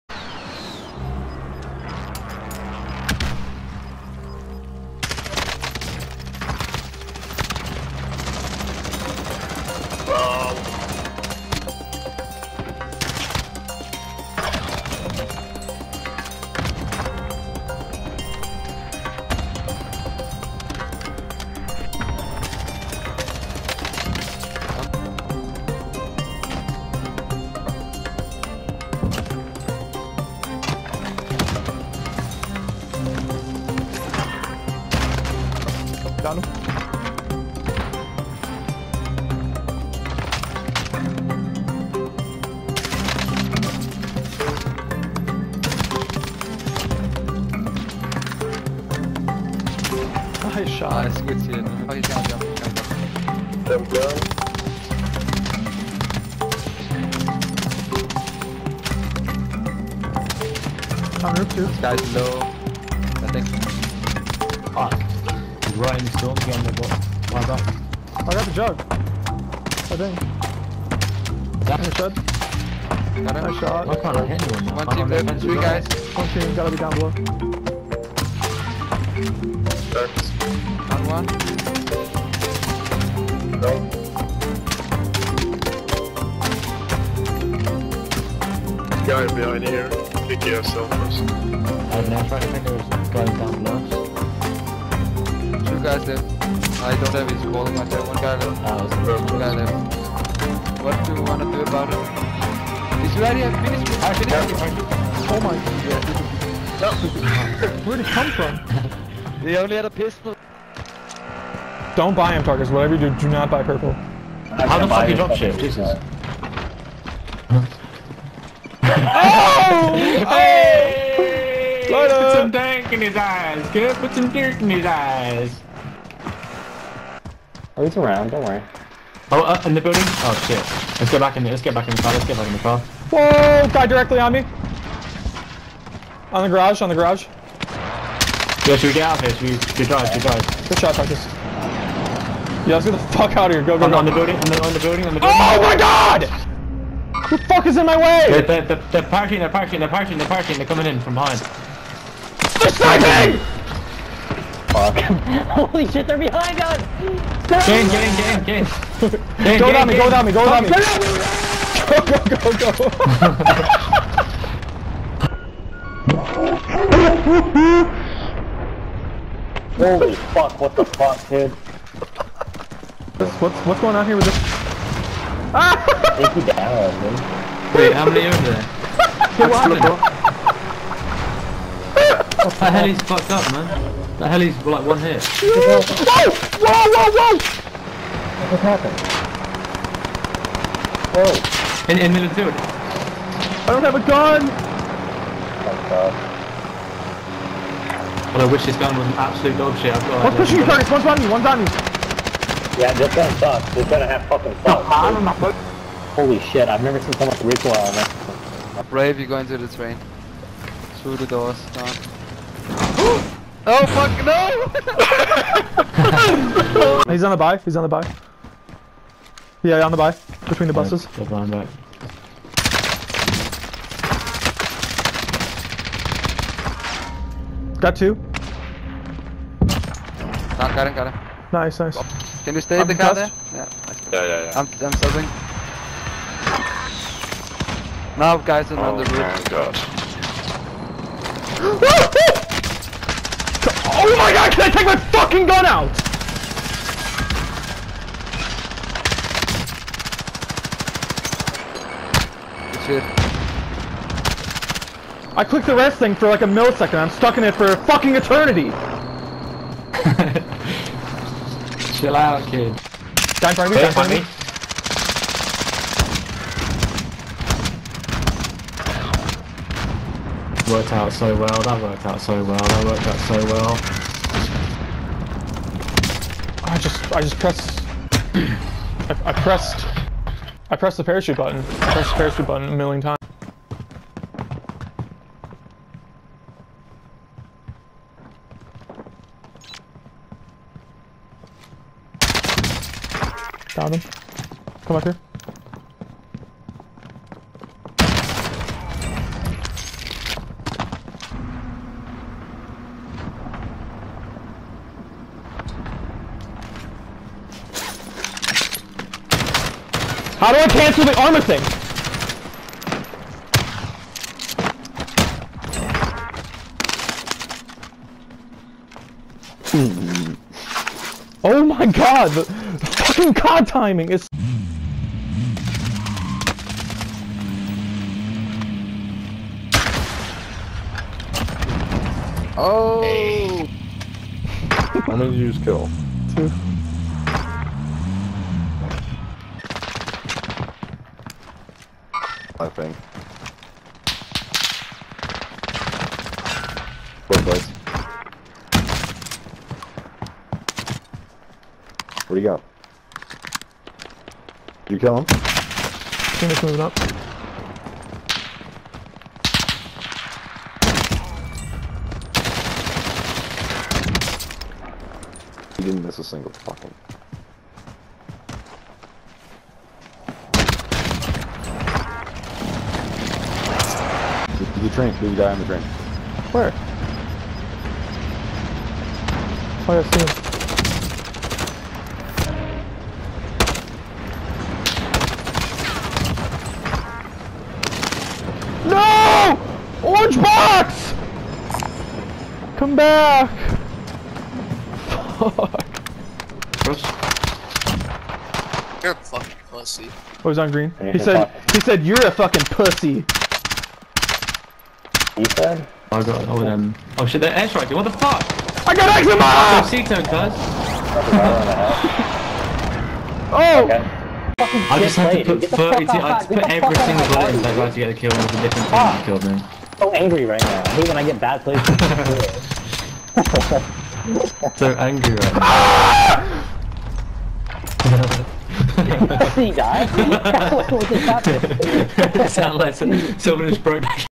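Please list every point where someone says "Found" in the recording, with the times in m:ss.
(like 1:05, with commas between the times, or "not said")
4:53.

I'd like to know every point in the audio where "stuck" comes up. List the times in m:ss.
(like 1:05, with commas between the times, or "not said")
4:17.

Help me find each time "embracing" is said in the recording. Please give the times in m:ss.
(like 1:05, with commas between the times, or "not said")
not said.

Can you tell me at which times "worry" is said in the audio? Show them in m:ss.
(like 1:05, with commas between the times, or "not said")
2:08.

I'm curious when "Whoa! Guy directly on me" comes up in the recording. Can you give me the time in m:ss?
2:12.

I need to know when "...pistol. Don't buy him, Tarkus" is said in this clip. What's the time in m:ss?
1:49.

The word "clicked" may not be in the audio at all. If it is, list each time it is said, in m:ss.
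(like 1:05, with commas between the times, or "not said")
4:15.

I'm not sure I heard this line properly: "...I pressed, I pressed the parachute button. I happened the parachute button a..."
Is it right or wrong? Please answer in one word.
wrong.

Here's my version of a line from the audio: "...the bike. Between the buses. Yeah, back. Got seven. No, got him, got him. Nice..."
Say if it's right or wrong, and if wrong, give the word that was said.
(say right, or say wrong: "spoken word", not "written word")
wrong: "two", not "seven".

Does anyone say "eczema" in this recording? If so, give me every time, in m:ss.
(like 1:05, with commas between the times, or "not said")
6:49.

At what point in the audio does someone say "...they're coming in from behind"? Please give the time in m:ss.
2:30.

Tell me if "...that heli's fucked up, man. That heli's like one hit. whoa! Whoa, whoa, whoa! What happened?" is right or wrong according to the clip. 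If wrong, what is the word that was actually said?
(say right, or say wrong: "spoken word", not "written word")
right.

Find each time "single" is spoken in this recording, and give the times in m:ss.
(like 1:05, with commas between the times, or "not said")
6:06, 6:56.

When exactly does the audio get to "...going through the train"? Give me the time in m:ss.
3:29.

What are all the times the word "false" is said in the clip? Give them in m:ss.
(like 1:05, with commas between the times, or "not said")
not said.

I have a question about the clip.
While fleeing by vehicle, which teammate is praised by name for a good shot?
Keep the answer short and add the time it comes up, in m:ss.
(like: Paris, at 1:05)
Marcus, at 2:20.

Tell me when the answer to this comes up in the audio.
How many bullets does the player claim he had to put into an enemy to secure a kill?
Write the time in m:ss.
6:55.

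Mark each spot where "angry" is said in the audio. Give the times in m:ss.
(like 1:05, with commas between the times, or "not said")
7:00, 7:04.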